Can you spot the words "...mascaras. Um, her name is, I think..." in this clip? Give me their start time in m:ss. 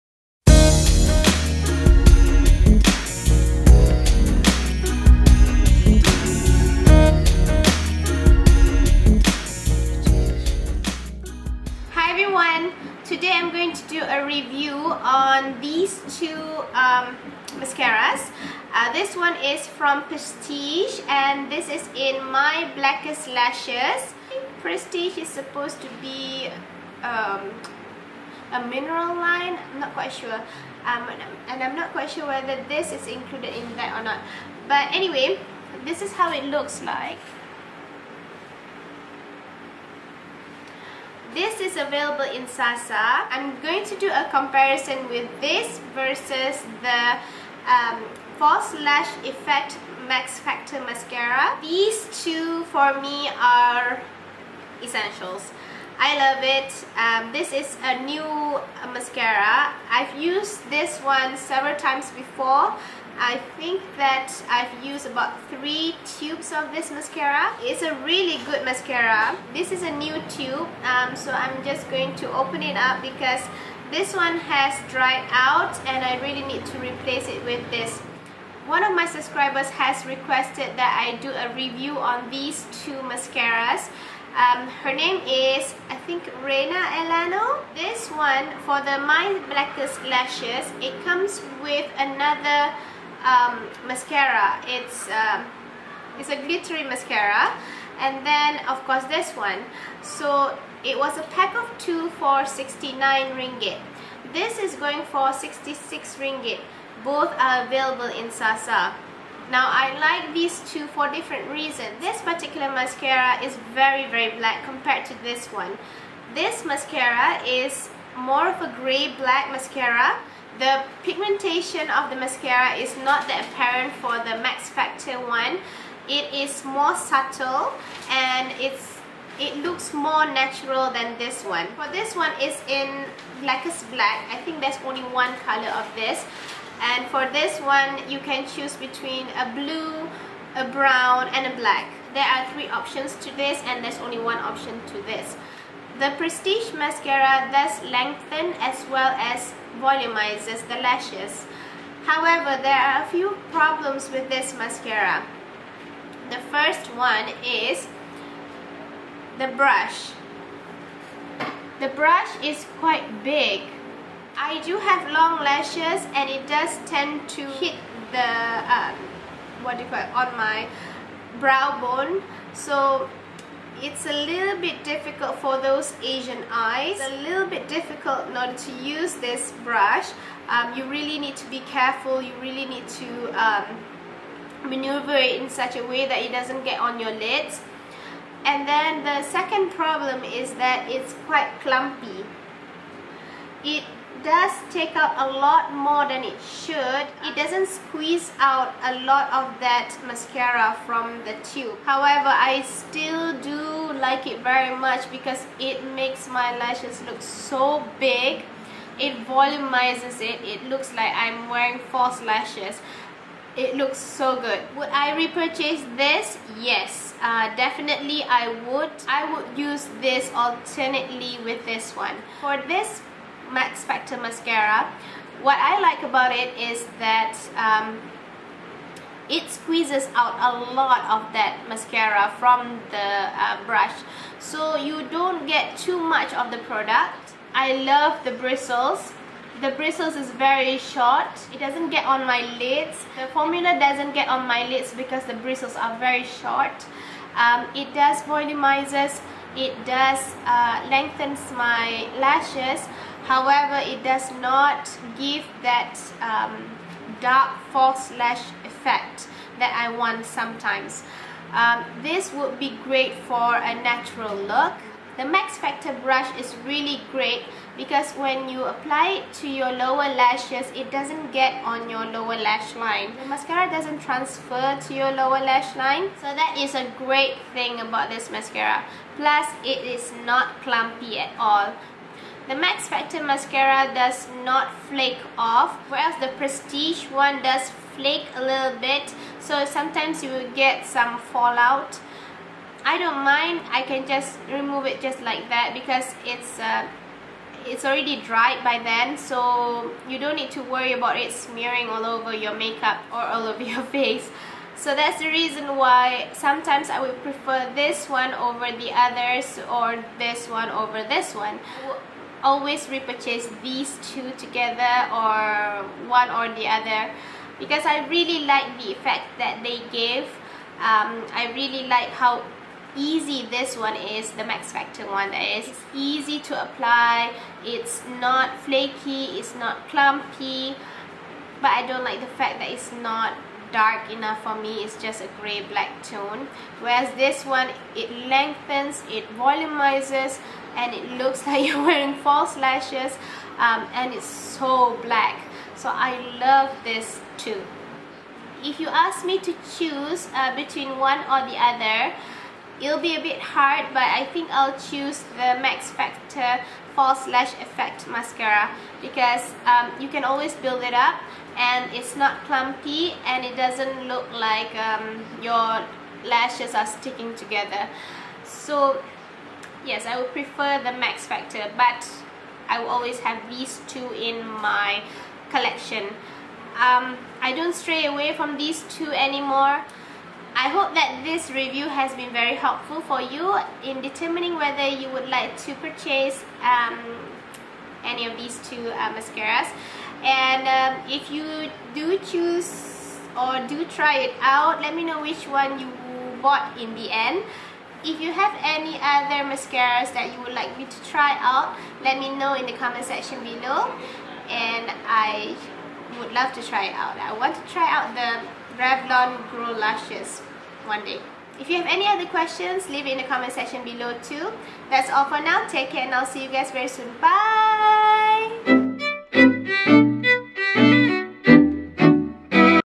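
1:23.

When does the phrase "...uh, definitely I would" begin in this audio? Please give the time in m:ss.
3:37.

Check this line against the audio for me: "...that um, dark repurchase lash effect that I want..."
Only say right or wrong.
wrong.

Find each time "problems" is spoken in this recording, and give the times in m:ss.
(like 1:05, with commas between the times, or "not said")
2:33, 3:09.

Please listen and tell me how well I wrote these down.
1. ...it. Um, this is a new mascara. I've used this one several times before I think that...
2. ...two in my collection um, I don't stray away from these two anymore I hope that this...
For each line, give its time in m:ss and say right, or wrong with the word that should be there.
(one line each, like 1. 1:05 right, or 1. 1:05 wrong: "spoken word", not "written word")
1. 0:56 right
2. 6:13 right.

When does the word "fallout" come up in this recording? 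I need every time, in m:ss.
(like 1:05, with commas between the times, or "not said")
4:51.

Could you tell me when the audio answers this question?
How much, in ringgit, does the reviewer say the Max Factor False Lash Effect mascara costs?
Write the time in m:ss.
1:45.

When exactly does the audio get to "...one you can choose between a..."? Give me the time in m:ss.
2:17.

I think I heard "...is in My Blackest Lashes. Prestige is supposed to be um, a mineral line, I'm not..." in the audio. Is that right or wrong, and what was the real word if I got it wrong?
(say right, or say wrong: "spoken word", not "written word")
right.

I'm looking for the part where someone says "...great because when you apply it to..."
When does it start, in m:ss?
4:27.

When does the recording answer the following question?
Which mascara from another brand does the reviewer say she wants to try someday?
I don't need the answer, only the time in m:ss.
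6:48.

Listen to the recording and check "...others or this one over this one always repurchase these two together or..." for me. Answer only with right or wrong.
right.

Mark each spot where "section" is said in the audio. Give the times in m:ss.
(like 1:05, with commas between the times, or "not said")
6:43, 6:53.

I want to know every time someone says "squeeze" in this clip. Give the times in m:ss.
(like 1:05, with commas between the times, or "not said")
3:17, 3:49.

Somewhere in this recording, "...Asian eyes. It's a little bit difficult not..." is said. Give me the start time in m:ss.
2:56.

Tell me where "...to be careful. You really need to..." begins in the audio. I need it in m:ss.
3:01.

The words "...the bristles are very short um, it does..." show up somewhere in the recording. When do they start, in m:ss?
4:05.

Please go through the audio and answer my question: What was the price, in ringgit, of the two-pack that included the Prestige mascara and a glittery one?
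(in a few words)
69 ringgit.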